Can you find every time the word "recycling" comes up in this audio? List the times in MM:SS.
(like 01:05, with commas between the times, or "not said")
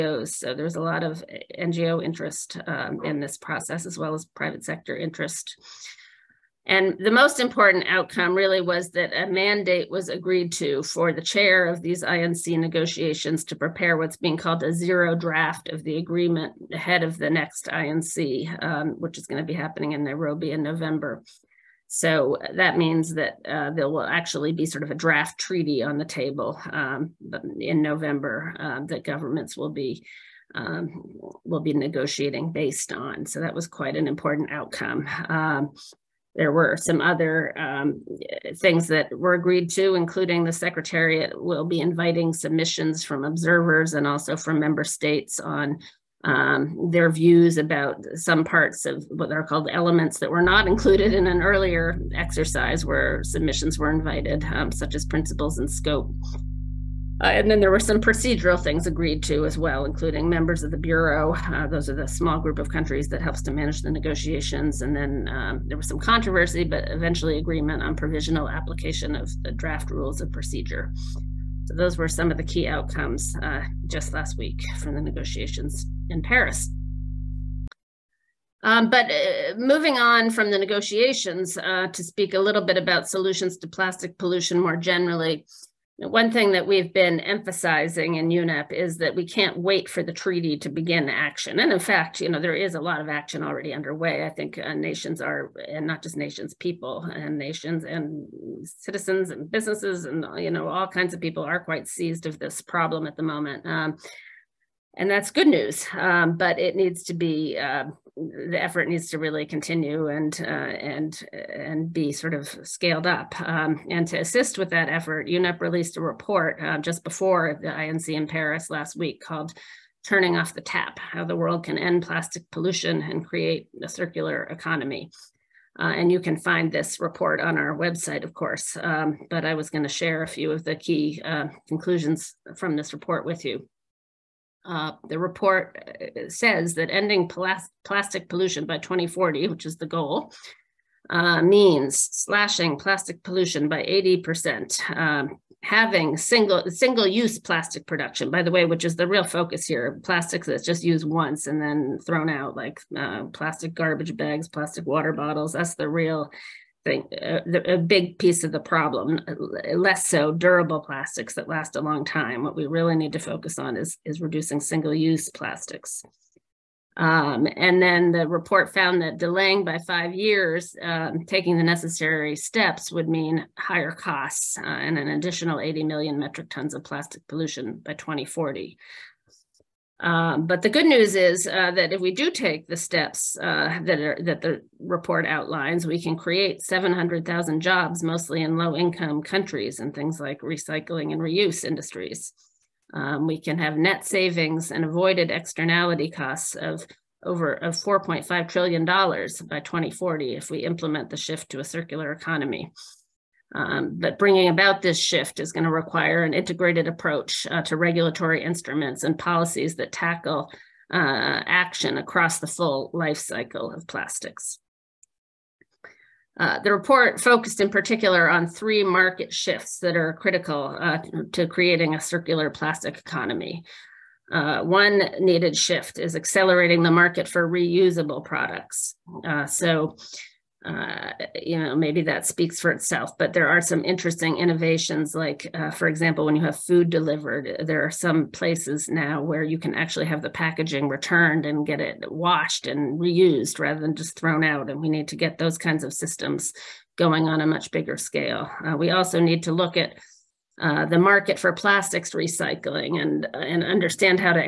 03:10, 04:12.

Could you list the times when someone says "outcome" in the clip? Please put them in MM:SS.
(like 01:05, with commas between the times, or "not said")
00:07, 00:34, 01:12.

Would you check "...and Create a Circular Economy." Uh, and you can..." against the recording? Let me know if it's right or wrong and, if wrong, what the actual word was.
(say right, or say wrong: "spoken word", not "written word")
right.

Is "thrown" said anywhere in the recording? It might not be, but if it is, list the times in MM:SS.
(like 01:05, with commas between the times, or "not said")
02:32, 04:04.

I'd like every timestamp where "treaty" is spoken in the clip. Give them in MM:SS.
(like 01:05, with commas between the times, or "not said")
00:25, 01:30.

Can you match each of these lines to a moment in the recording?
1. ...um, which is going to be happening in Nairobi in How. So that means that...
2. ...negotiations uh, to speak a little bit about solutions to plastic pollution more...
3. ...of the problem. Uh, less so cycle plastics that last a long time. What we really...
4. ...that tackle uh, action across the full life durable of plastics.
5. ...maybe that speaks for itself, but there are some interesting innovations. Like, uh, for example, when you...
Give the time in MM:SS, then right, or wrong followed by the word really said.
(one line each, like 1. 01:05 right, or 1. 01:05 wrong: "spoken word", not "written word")
1. 00:18 wrong: "November", not "How"
2. 01:20 right
3. 02:38 wrong: "durable", not "cycle"
4. 03:29 wrong: "cycle", not "durable"
5. 03:51 right.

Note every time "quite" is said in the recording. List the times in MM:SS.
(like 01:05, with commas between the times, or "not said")
00:33, 01:41.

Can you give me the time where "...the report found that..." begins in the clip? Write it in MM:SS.
02:48.